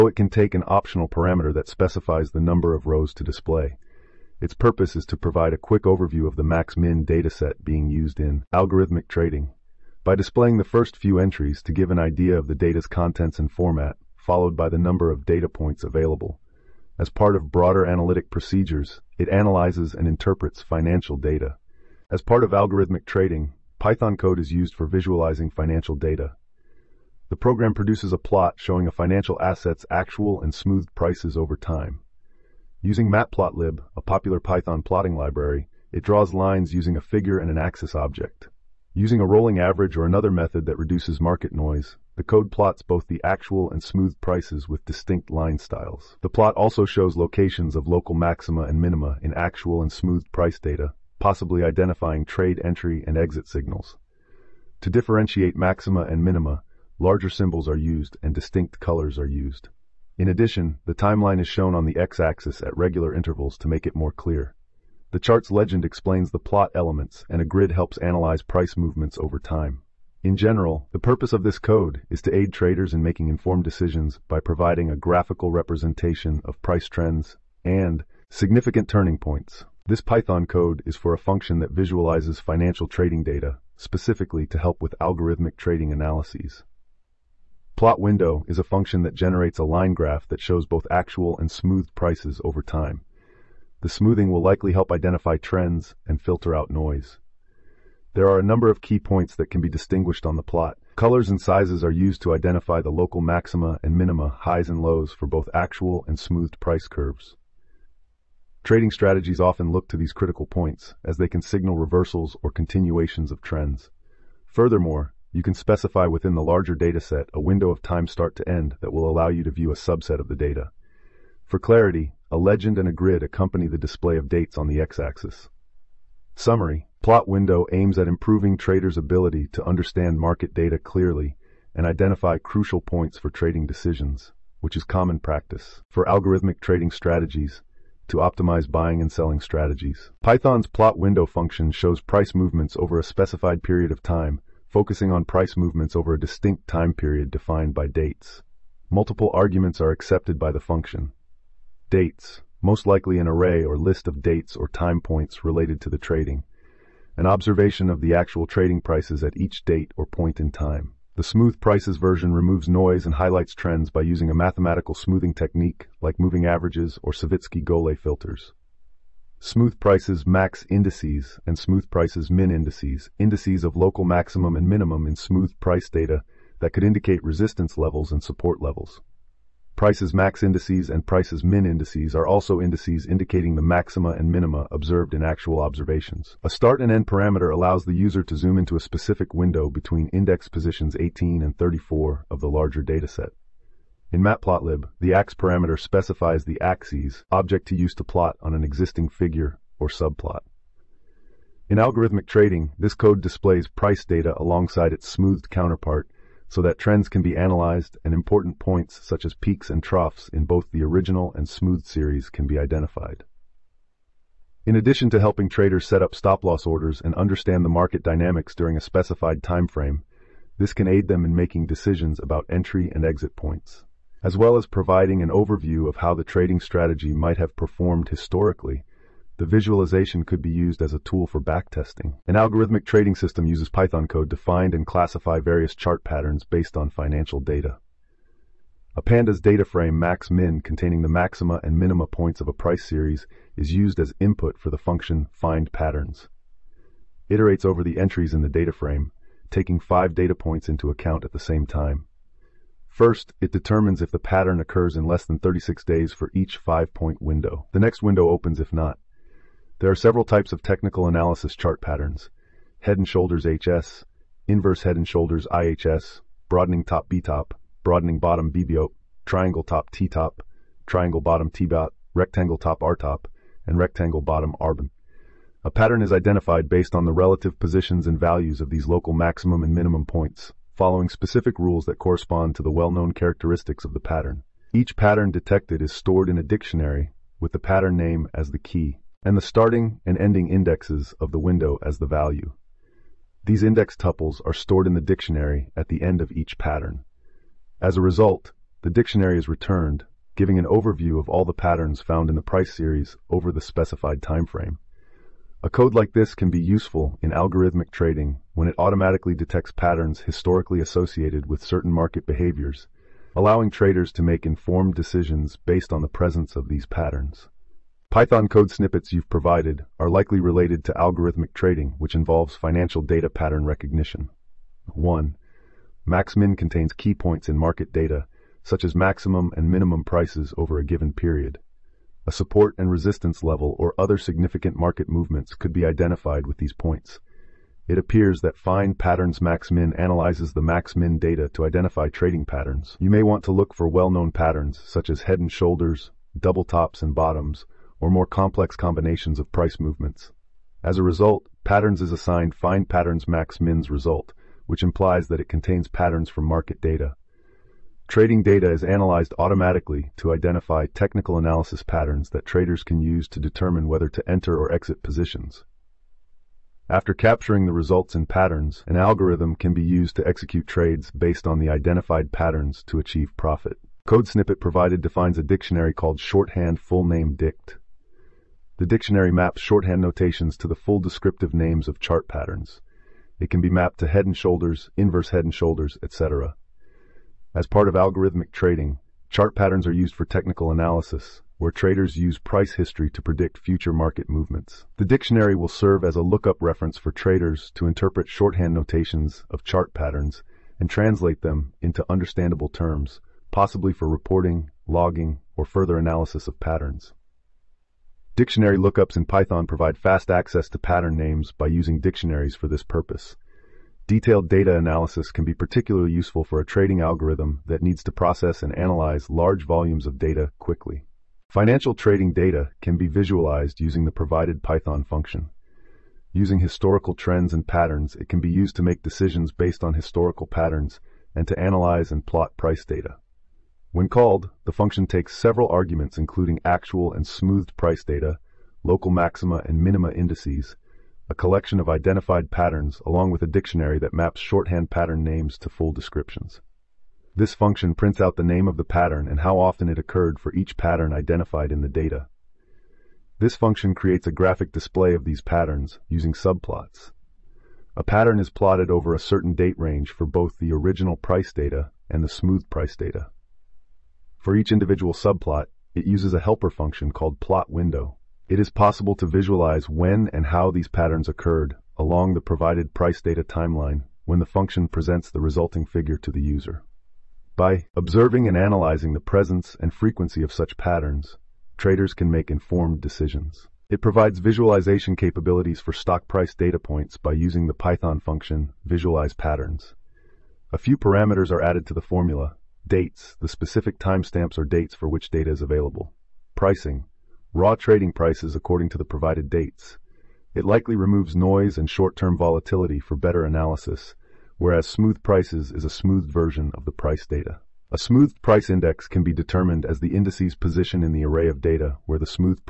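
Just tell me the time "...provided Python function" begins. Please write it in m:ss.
7:04.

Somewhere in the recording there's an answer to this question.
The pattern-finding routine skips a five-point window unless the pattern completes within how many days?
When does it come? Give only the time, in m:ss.
4:15.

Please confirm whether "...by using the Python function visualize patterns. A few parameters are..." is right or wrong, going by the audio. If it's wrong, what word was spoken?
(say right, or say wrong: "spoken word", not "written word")
right.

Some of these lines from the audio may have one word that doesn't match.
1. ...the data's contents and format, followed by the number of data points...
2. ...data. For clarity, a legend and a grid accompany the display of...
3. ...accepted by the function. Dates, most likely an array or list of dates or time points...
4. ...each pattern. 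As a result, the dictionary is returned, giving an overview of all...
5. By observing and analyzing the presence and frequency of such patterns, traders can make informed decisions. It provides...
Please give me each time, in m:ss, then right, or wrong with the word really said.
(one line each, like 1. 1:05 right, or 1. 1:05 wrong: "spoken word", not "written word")
1. 0:12 right
2. 2:00 right
3. 2:29 right
4. 4:56 right
5. 7:57 right.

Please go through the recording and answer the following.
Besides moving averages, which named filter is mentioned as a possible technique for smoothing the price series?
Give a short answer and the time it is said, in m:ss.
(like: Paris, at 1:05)
Savitzky-Golay, at 2:47.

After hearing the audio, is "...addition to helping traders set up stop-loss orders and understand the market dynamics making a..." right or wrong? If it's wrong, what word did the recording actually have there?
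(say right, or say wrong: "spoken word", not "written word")
wrong: "during", not "making".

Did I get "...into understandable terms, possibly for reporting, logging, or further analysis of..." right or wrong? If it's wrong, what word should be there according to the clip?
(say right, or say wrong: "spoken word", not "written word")
right.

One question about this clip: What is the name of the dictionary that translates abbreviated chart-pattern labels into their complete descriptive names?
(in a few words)
shorthand full name dict.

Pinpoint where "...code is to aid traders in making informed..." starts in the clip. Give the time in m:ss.
1:11.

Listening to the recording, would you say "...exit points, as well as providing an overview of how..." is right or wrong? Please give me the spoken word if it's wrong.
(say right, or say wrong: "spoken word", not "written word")
right.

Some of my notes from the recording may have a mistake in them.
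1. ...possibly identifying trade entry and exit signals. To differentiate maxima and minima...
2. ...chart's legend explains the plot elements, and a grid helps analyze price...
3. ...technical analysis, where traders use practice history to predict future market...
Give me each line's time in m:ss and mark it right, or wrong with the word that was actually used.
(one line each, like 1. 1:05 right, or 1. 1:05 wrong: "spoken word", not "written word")
1. 0:51 right
2. 1:05 right
3. 6:30 wrong: "price", not "practice".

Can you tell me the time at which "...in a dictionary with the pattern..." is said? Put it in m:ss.
4:46.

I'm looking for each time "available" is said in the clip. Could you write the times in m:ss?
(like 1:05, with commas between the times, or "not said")
0:15, 8:15.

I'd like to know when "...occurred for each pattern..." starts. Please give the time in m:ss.
7:29.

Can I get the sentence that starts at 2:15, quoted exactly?
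For algorithmic trading strategies, to optimize buying and selling strategies.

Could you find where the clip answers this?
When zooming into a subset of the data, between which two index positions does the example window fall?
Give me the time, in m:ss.
3:10.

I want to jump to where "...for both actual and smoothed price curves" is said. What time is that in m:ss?
1:45.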